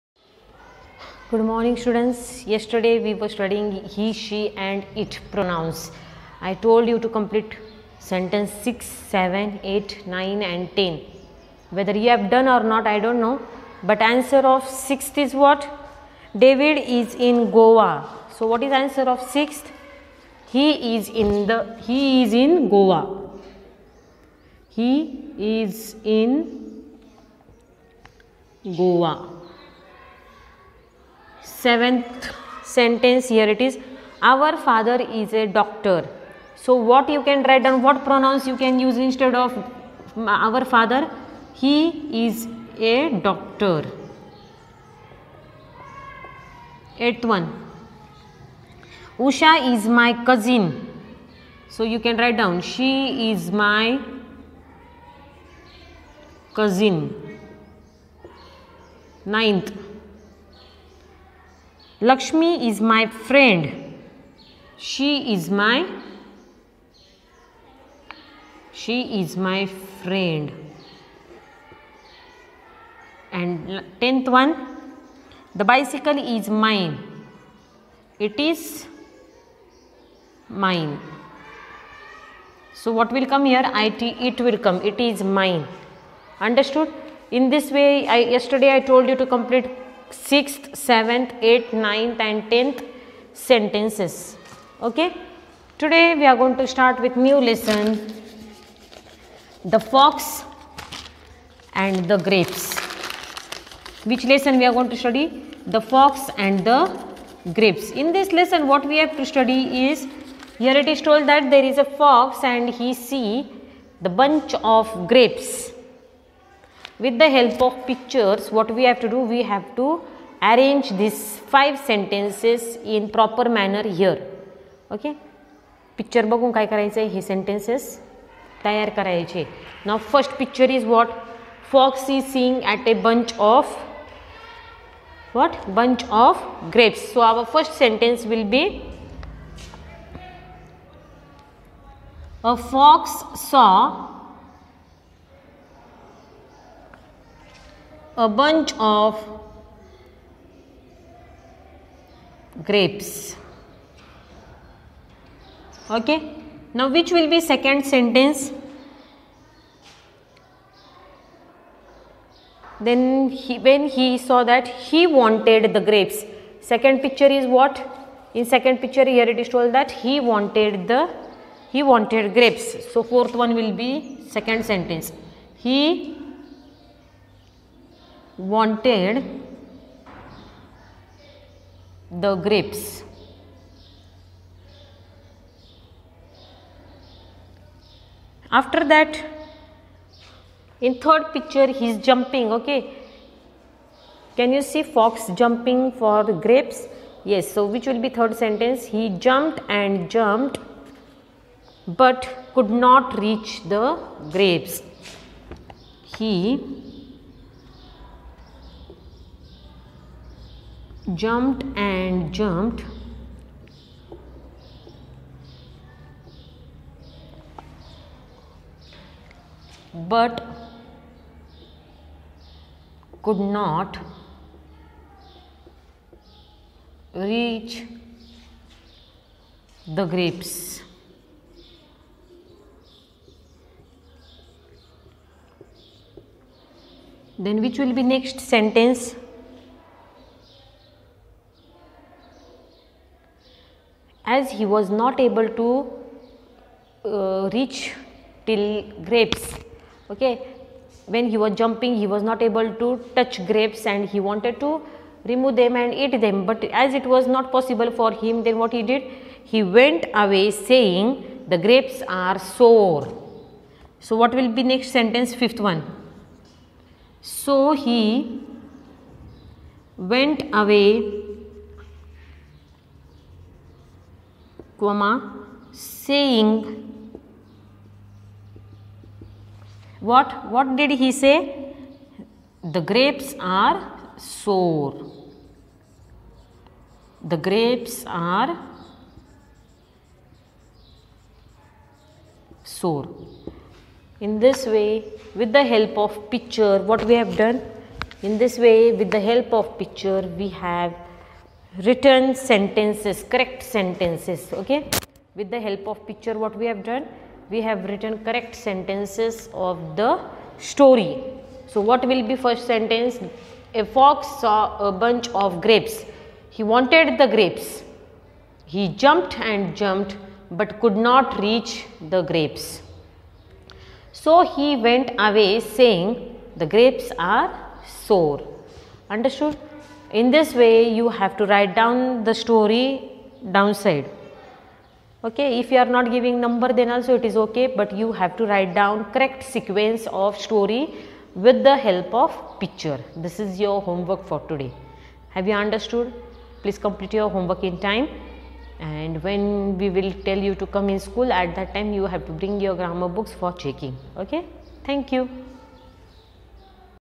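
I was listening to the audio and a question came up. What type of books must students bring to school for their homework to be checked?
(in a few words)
grammar books.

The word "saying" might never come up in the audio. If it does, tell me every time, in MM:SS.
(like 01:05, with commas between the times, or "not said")
04:20, 04:36, 05:25.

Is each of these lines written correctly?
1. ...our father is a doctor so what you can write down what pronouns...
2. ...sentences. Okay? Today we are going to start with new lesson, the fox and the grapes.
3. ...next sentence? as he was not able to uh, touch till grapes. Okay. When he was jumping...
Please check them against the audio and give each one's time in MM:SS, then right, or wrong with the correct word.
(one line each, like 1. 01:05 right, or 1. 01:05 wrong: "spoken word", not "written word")
1. 00:34 right
2. 01:33 right
3. 03:58 wrong: "reach", not "touch".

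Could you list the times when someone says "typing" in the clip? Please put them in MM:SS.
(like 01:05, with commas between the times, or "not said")
not said.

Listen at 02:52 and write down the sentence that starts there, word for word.
So fourth one will be second sentence.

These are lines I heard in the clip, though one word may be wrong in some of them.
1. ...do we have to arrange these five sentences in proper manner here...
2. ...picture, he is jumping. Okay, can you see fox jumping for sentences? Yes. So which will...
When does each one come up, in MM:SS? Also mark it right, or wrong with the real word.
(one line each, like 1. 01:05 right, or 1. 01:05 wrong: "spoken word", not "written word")
1. 01:59 right
2. 03:11 wrong: "grapes", not "sentences".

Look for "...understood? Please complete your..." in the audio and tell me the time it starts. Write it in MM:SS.
05:45.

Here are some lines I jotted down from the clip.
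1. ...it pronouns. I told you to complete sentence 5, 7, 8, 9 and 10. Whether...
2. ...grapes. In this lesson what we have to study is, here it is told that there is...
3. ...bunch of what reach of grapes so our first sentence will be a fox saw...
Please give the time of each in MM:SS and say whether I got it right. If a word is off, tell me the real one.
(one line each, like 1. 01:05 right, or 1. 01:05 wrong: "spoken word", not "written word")
1. 00:04 wrong: "6", not "5"
2. 01:47 right
3. 02:13 wrong: "bunch", not "reach".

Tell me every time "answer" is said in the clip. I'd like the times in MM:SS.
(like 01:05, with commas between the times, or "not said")
00:14, 00:18.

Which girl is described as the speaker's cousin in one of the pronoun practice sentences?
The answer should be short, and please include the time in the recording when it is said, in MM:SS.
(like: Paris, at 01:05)
Usha, at 00:49.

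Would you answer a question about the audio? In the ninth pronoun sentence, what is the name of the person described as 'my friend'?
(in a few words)
Lakshmi.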